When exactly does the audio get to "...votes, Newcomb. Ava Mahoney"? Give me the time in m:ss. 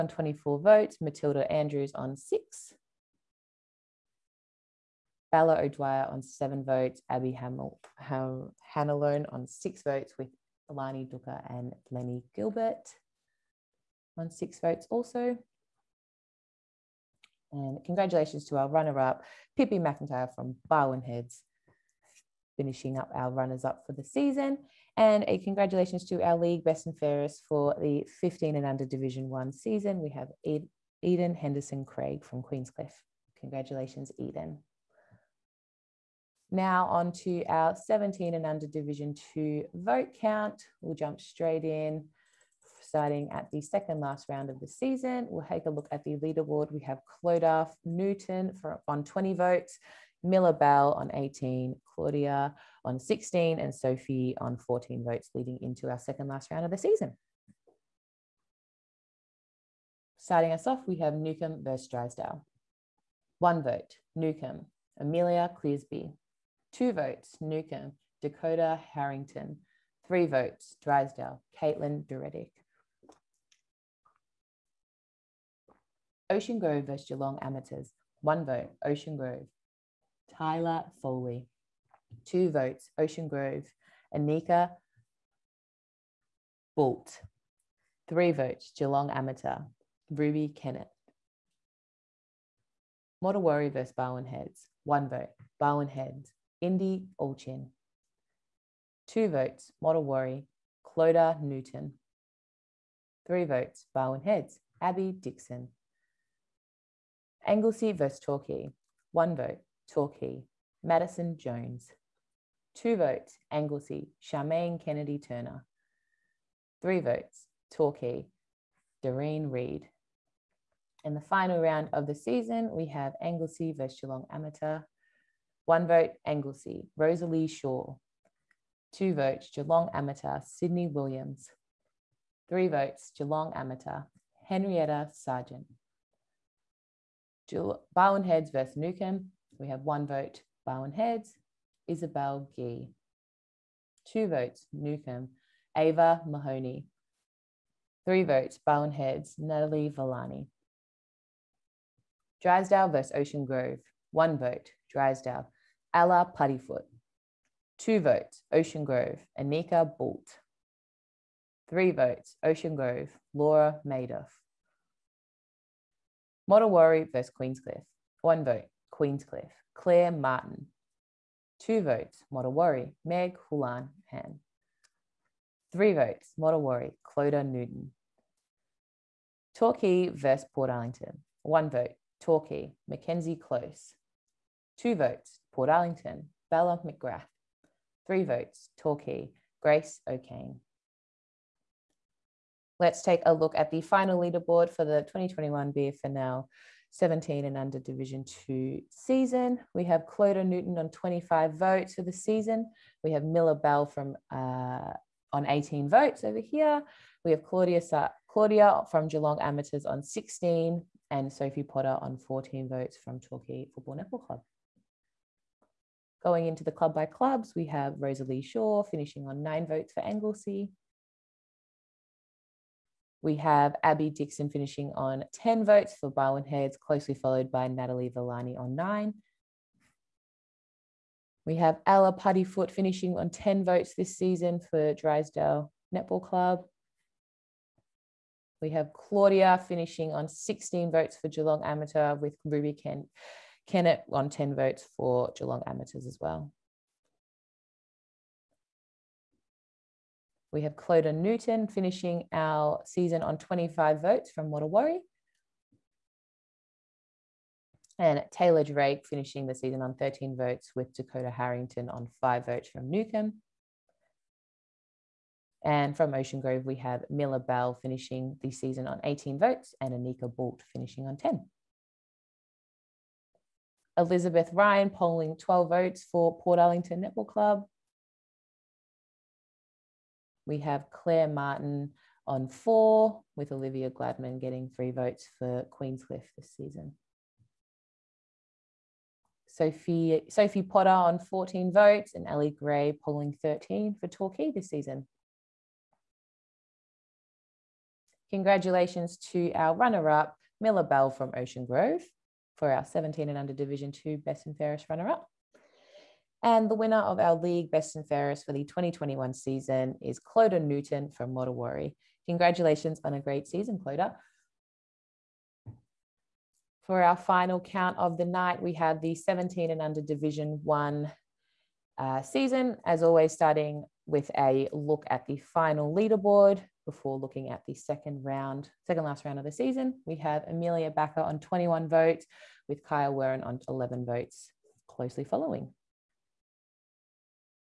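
2:24.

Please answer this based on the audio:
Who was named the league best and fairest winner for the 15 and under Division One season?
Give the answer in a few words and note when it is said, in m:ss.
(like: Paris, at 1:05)
Eden Henderson Craig, at 0:31.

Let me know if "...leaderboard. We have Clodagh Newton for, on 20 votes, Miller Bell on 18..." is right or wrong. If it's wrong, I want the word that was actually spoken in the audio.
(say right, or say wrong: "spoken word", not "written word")
right.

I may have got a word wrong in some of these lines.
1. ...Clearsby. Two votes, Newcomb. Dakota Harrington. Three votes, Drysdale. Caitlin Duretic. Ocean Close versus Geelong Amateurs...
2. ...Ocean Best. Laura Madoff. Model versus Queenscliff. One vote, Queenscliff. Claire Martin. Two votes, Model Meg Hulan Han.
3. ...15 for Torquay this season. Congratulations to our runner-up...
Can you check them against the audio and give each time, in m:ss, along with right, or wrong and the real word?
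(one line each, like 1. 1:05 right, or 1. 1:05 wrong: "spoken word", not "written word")
1. 1:05 wrong: "Grove", not "Close"
2. 2:42 wrong: "Grove", not "Best"
3. 4:53 wrong: "13", not "15".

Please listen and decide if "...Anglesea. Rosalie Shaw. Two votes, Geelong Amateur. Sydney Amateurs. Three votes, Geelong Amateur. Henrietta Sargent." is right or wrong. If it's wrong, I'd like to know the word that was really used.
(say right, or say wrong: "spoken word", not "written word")
wrong: "Williams", not "Amateurs".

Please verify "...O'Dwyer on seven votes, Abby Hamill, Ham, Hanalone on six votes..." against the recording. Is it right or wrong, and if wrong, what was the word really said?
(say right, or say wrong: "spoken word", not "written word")
right.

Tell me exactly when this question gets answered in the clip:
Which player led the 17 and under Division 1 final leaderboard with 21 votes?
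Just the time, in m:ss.
5:30.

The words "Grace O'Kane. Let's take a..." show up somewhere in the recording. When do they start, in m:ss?
3:09.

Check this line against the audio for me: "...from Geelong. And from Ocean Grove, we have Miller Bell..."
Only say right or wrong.
wrong.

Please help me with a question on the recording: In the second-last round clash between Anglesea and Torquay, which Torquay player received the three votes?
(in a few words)
Doreen Reid.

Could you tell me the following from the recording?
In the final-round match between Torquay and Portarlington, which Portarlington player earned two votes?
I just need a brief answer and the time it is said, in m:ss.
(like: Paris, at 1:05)
Bella McGrath, at 3:06.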